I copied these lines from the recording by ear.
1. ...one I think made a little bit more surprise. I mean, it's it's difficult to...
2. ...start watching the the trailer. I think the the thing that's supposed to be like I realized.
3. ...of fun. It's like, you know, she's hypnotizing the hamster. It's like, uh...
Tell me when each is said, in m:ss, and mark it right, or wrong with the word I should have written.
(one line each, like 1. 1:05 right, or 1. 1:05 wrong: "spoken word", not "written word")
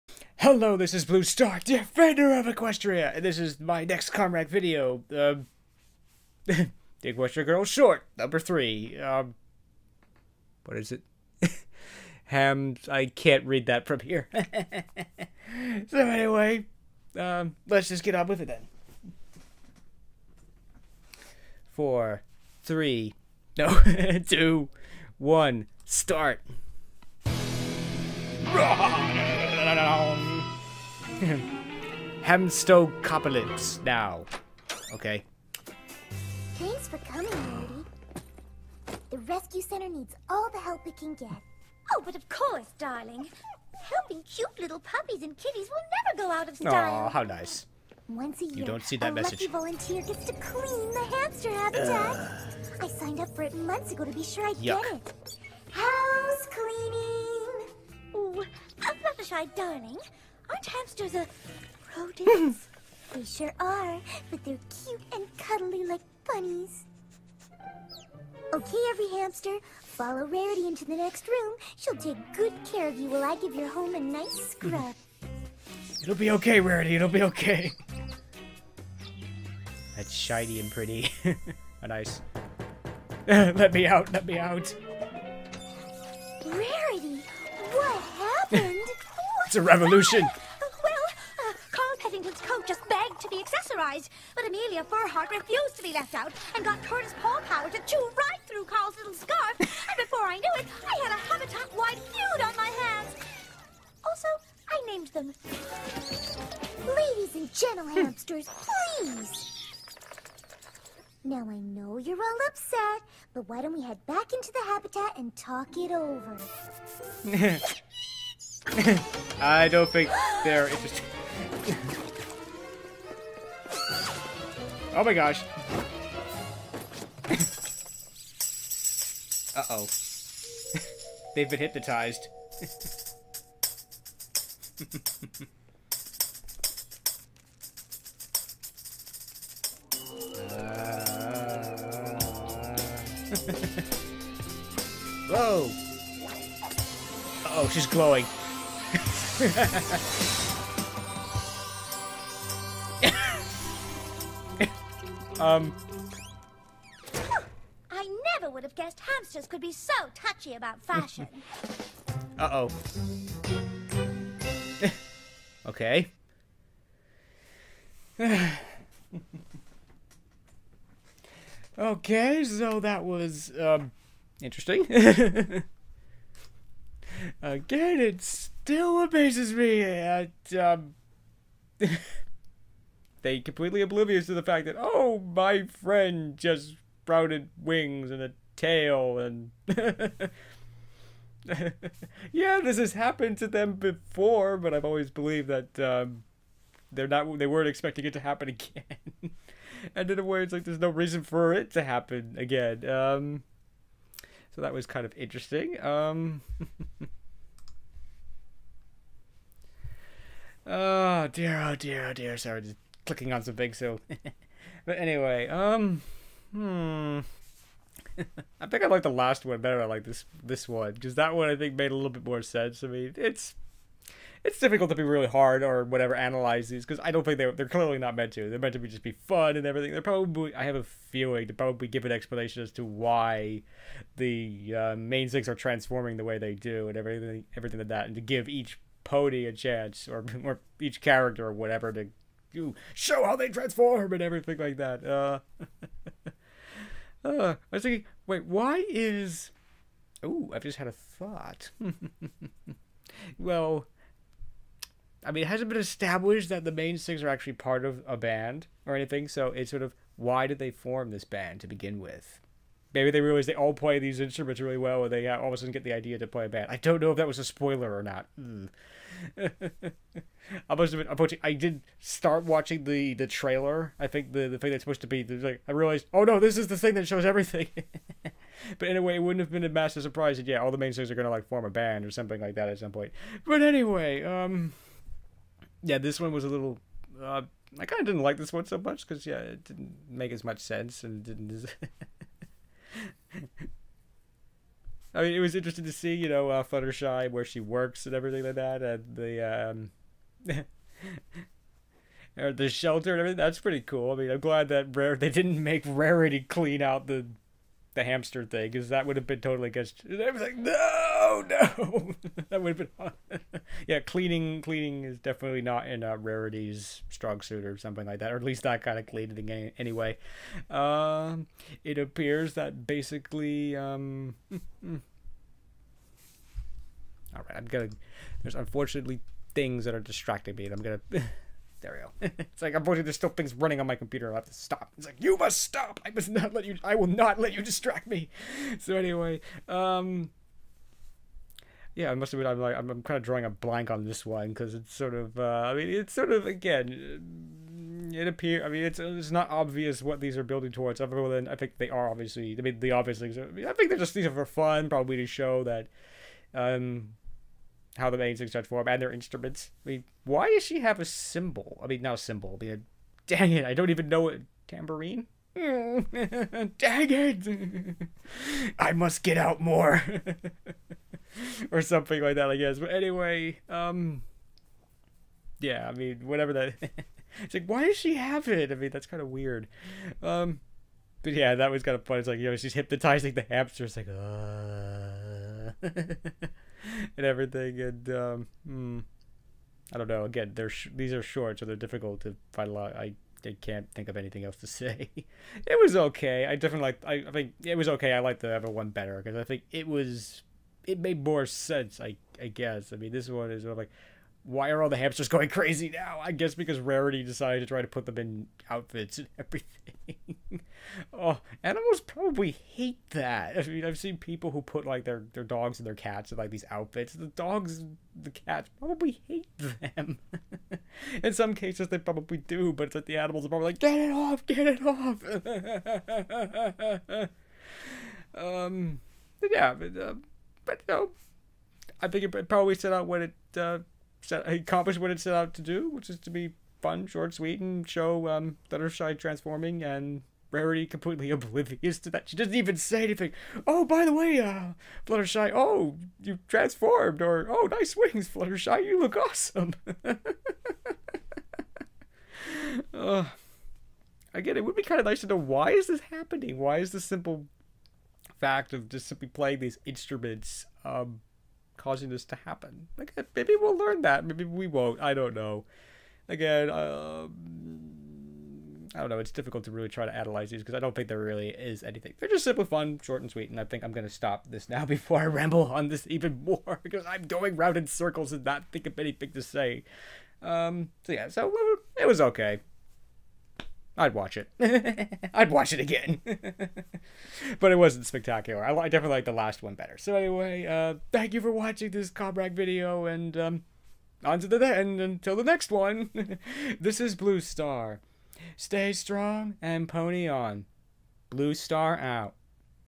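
1. 3:41 wrong: "sense", not "surprise"
2. 4:31 right
3. 6:21 right.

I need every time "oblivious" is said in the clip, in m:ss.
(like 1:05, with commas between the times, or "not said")
3:03, 7:21.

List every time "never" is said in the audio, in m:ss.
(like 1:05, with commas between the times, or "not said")
0:46, 2:38.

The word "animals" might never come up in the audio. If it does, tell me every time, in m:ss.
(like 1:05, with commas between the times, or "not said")
6:51, 7:03.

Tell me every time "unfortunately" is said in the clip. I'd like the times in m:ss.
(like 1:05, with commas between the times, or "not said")
5:28, 5:32.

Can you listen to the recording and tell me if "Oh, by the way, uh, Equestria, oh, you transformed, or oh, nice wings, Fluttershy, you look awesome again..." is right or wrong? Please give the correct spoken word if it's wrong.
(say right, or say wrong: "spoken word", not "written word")
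wrong: "Fluttershy", not "Equestria".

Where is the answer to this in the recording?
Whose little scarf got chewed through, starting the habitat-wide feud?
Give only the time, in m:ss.
1:38.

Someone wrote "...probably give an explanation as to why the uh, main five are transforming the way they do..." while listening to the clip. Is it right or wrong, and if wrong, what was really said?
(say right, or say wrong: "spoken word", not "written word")
wrong: "six", not "five".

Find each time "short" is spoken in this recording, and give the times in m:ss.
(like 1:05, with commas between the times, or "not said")
0:07, 6:31, 7:17, 7:53.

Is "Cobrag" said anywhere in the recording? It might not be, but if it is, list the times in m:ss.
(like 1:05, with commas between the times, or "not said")
8:12.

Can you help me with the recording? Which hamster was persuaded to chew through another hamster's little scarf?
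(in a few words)
Curtis Paw Power.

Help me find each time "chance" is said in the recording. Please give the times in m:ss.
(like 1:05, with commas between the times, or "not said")
3:59.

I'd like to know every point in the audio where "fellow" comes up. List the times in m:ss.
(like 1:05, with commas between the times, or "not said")
not said.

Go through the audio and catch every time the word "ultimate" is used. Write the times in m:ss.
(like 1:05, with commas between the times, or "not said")
not said.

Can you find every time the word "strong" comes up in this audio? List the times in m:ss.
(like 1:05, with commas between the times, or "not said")
5:17, 8:18.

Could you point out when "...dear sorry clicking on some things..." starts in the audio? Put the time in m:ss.
3:32.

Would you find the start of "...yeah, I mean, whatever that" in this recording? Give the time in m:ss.
6:15.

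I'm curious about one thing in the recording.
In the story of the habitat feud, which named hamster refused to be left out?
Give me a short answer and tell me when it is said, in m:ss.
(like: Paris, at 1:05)
Amelia Furhart, at 1:34.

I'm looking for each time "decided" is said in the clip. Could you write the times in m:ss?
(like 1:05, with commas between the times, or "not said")
6:47.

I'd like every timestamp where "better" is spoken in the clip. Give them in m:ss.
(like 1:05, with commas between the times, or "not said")
3:39, 6:38, 8:09.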